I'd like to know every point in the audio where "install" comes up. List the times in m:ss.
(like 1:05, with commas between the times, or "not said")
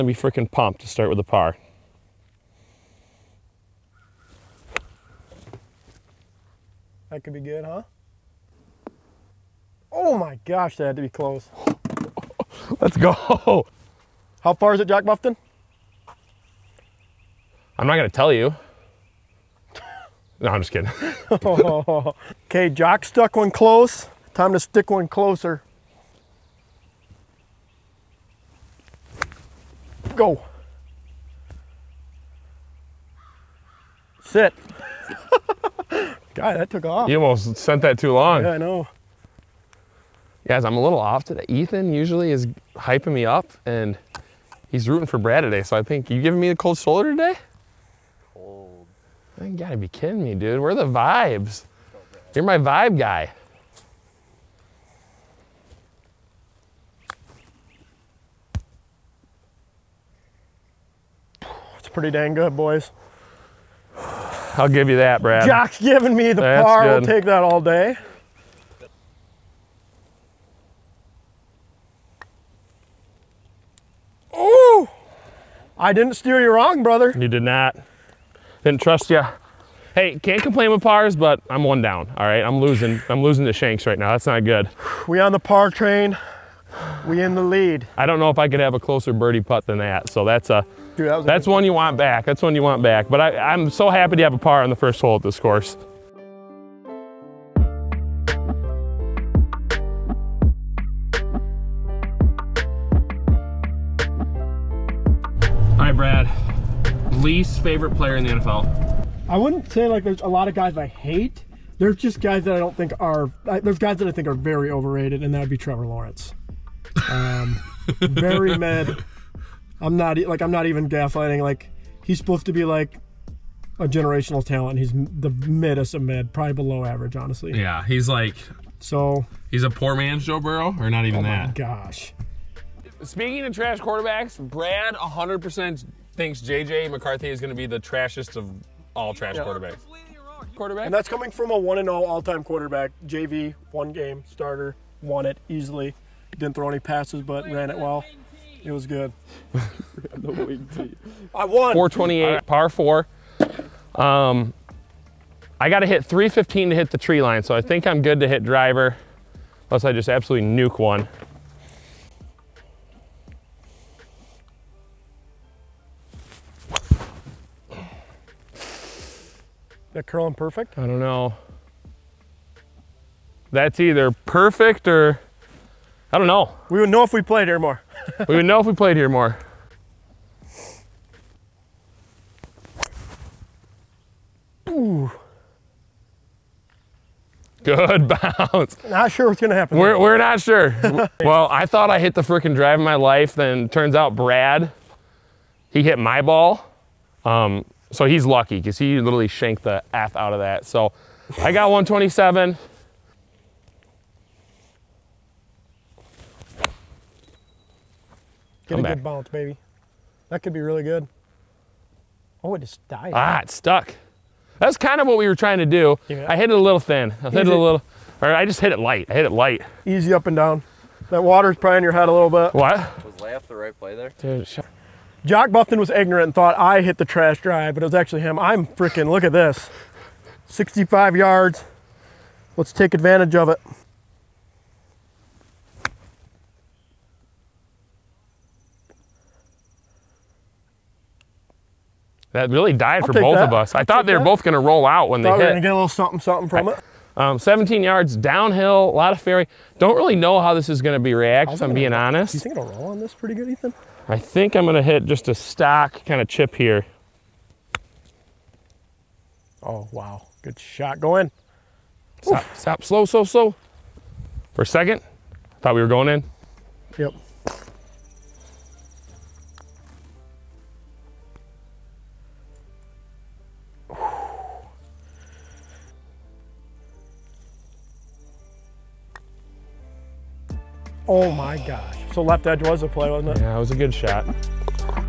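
not said.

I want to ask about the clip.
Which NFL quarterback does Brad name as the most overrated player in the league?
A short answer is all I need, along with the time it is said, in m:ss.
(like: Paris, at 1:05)
Trevor Lawrence, at 1:55.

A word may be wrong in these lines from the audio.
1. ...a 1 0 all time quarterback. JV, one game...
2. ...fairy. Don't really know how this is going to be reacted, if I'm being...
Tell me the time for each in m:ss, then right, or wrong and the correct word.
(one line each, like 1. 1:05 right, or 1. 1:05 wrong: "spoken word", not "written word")
1. 2:21 right
2. 4:09 right.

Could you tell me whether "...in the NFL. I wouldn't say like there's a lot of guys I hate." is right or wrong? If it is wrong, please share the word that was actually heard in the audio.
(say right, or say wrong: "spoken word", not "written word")
right.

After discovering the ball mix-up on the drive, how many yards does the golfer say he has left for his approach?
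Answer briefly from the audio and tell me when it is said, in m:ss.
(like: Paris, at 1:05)
127, at 3:21.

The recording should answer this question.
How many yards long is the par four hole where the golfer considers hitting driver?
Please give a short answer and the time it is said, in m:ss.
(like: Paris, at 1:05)
428, at 2:31.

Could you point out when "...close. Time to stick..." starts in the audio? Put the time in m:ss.
0:23.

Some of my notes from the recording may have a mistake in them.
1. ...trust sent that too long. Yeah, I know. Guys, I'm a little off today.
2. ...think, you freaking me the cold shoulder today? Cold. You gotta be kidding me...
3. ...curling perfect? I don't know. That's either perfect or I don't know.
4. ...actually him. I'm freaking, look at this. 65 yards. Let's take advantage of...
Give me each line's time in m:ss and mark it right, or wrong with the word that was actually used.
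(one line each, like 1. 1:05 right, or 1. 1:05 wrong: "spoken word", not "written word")
1. 0:37 wrong: "almost", not "trust"
2. 0:45 wrong: "giving", not "freaking"
3. 2:50 right
4. 3:47 right.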